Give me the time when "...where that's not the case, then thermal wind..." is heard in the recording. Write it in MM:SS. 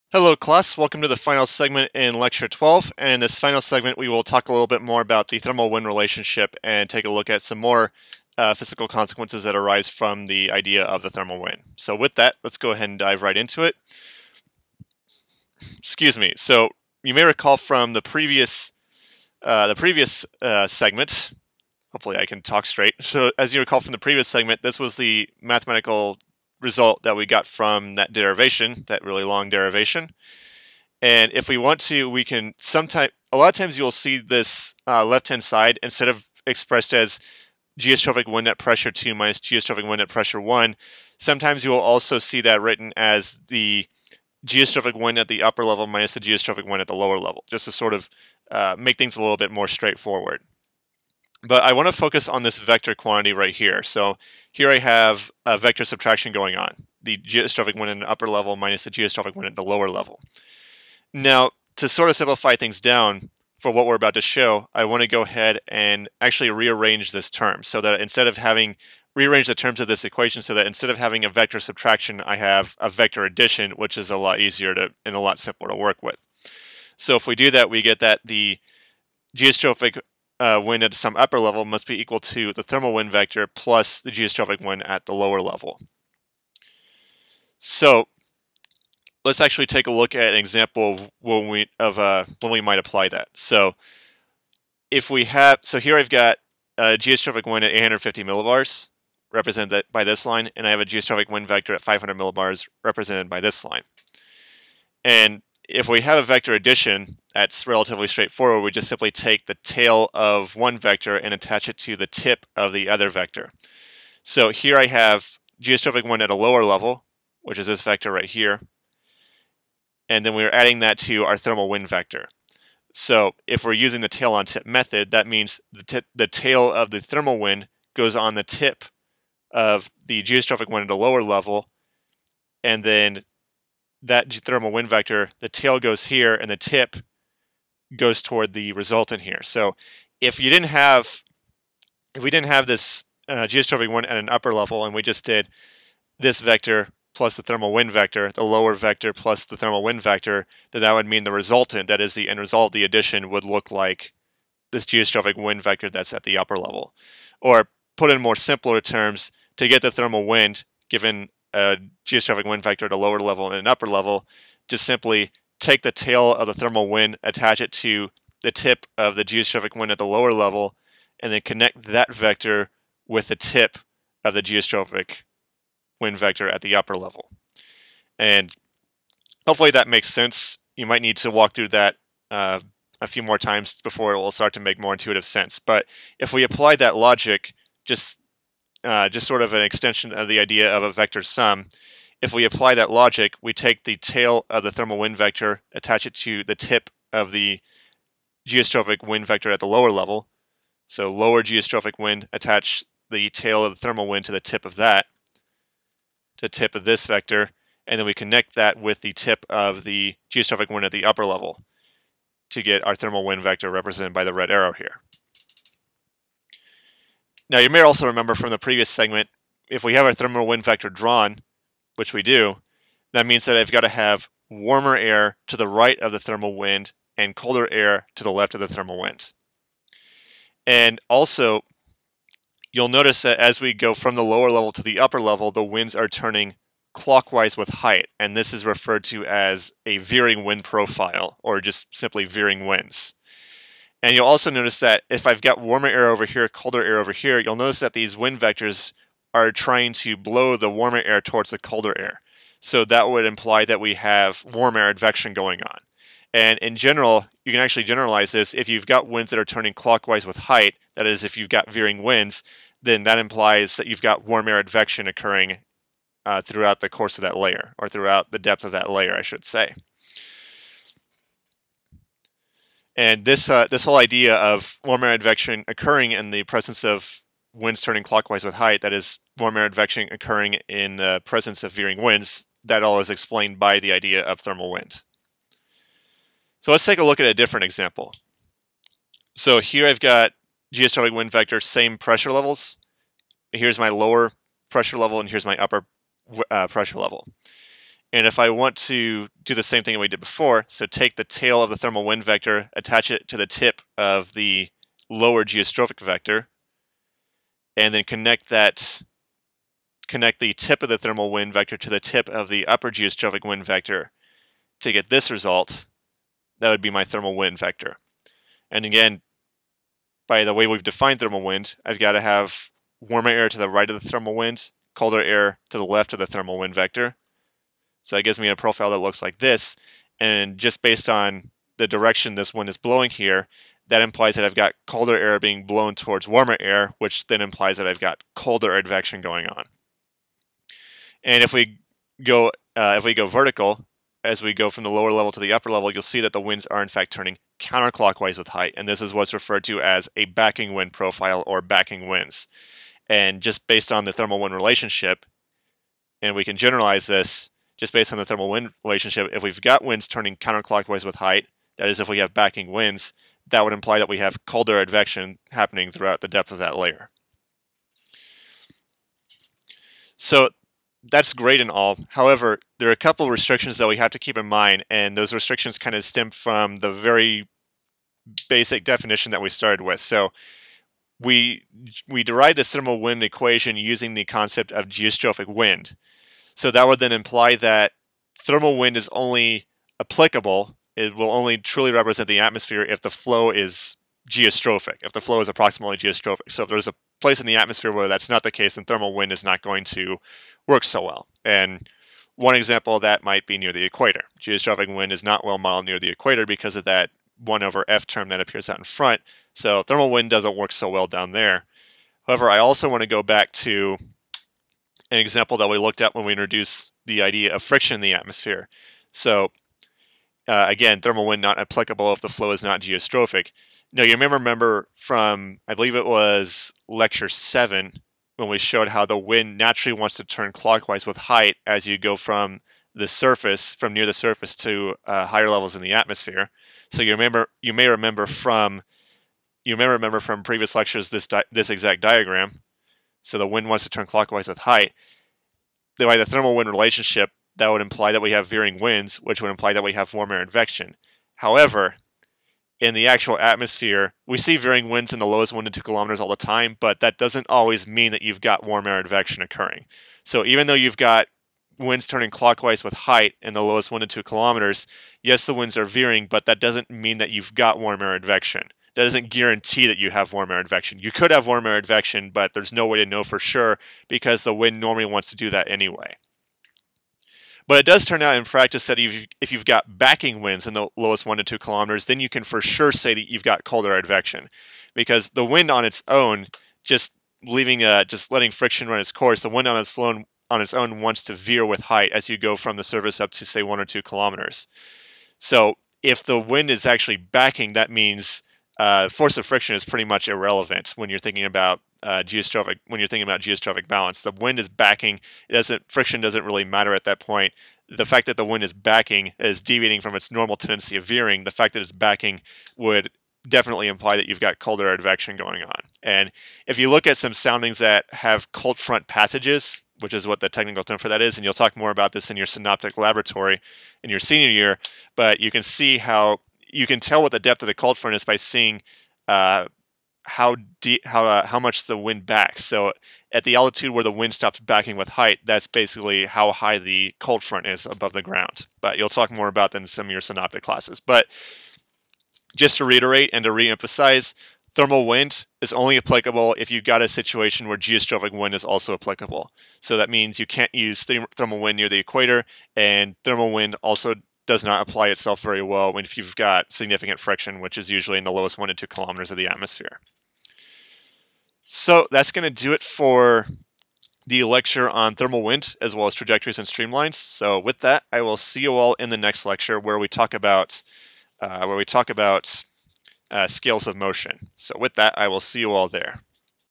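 06:37.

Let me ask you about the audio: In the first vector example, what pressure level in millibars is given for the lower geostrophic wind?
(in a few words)
850 millibars.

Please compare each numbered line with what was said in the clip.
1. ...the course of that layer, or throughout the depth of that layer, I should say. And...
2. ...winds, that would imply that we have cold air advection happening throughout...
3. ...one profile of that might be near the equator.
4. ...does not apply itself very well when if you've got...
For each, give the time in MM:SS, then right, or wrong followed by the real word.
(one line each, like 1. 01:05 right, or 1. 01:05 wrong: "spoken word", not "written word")
1. 04:26 right
2. 06:02 right
3. 06:42 wrong: "example", not "profile"
4. 09:14 right.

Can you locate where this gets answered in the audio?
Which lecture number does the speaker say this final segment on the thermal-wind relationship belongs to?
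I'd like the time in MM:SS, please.
00:02.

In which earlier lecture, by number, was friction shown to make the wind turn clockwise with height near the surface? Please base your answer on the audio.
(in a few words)
lecture 7.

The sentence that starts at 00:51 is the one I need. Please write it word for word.
But I want to focus on this vector quantity right here.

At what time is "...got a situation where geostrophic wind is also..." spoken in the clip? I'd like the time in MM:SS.
09:06.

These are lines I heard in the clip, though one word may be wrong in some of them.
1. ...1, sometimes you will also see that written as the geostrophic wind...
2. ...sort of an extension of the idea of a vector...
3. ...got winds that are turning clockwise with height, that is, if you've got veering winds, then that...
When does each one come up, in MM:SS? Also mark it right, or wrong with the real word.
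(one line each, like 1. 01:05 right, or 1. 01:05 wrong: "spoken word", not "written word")
1. 00:40 right
2. 03:09 right
3. 04:18 right.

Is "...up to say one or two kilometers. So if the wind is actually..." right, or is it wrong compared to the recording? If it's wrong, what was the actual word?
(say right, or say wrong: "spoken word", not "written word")
right.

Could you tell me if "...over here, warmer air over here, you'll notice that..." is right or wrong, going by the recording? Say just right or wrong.
wrong.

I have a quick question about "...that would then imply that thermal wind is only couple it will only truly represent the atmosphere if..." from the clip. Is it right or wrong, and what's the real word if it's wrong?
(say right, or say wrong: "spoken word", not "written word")
wrong: "applicable", not "couple".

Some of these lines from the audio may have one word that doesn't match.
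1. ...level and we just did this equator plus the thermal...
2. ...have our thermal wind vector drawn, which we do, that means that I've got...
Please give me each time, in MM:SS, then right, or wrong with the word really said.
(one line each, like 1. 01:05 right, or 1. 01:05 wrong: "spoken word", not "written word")
1. 02:24 wrong: "vector", not "equator"
2. 03:39 right.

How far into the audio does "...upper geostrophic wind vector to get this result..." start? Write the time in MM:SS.
05:12.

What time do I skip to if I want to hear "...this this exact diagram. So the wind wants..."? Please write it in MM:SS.
07:21.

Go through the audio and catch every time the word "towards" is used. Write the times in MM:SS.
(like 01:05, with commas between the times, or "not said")
02:18, 04:11, 05:35.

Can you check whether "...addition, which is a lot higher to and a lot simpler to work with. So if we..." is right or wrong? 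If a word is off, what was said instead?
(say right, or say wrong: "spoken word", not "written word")
wrong: "easier", not "higher".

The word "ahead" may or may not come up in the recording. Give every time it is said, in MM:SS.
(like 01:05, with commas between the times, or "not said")
00:12, 01:05.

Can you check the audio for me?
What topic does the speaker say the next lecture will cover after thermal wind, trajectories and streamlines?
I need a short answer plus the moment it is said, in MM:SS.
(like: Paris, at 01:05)
scales of motion, at 09:33.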